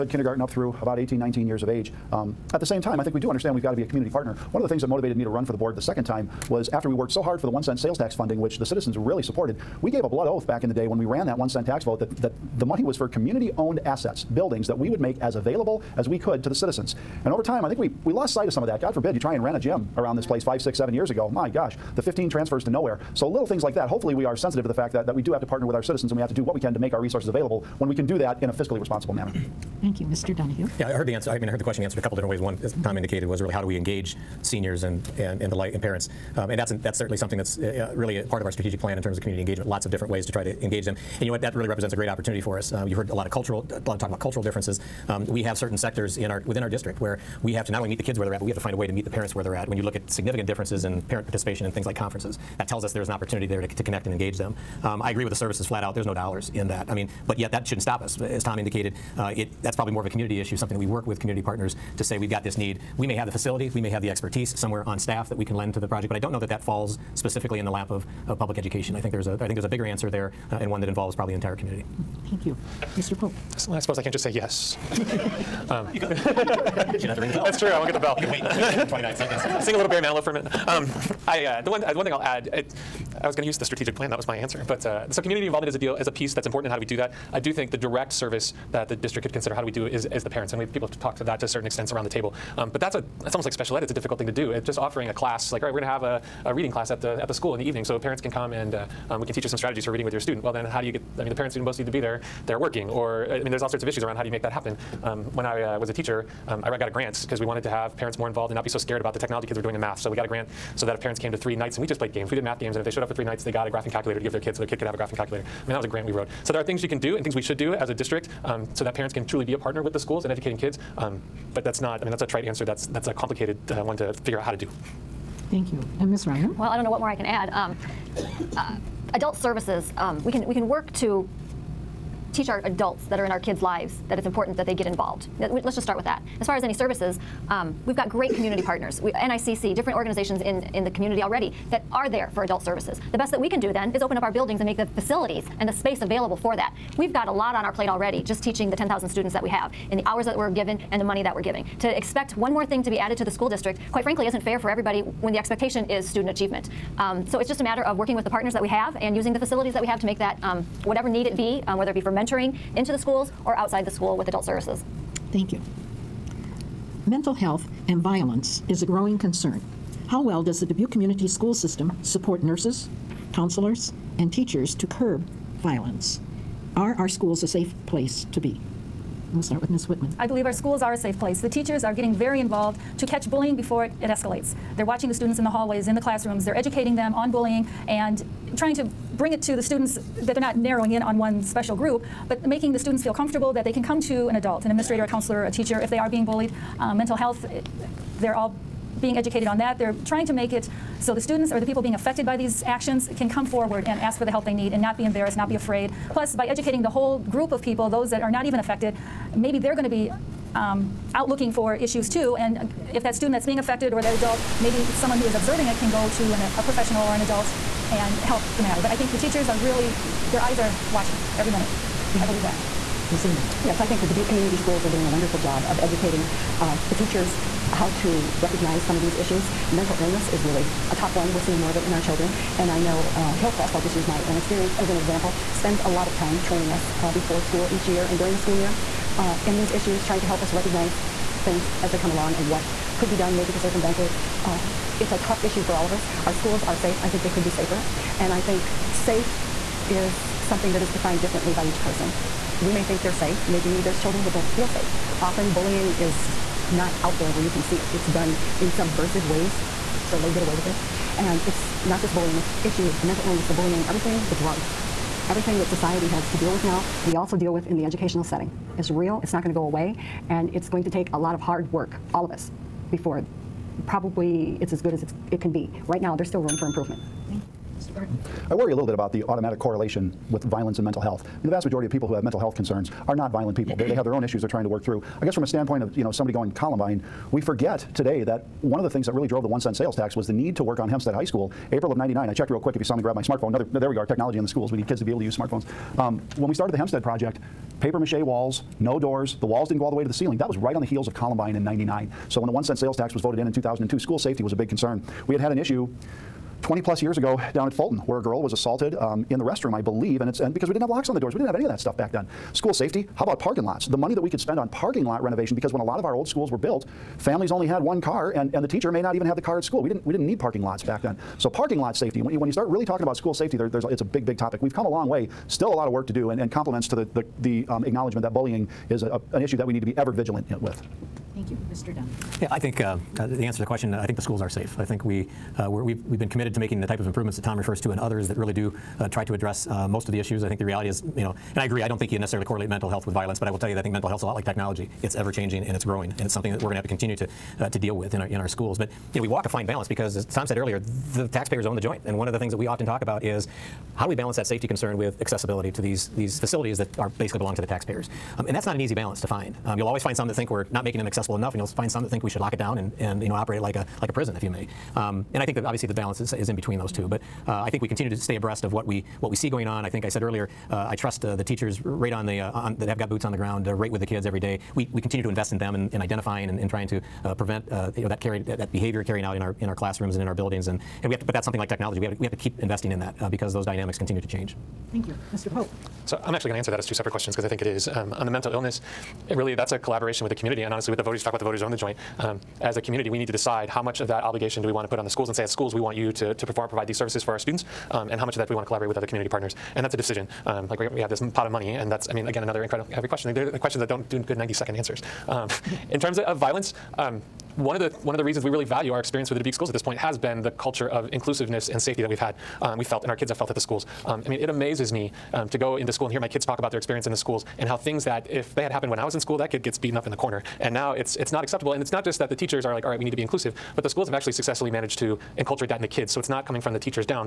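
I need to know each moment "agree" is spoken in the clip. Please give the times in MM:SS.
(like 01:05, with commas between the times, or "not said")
00:55, 05:41.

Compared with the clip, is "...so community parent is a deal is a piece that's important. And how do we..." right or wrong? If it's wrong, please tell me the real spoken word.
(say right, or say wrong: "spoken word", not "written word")
wrong: "involvement", not "parent".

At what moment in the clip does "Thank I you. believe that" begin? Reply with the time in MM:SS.
03:42.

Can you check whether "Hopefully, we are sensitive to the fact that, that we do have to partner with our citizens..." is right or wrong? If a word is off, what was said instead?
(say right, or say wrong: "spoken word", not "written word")
right.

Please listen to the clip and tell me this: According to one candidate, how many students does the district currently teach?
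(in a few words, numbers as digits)
10,000.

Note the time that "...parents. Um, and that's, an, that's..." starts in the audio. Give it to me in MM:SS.
00:35.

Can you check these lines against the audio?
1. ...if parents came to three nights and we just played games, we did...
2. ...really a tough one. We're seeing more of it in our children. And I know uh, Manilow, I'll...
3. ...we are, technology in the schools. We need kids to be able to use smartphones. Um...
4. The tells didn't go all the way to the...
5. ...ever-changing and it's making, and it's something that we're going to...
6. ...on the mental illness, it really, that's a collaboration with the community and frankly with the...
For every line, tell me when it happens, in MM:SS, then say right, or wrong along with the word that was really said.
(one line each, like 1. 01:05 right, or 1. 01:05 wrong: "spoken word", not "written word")
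1. 01:50 right
2. 03:50 wrong: "Hillcrest", not "Manilow"
3. 04:53 right
4. 04:59 wrong: "walls", not "tells"
5. 05:45 wrong: "growing", not "making"
6. 06:28 wrong: "honestly", not "frankly".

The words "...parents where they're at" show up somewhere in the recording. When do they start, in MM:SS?
00:49.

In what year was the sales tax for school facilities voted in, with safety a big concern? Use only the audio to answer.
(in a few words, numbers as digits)
2002.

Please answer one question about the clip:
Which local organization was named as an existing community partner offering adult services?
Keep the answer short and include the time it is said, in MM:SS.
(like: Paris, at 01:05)
NICC, at 02:19.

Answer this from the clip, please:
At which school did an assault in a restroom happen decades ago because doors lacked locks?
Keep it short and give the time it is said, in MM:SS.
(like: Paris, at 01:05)
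Fulton, at 05:07.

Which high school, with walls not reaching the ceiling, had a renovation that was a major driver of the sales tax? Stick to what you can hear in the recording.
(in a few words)
Hempstead High School.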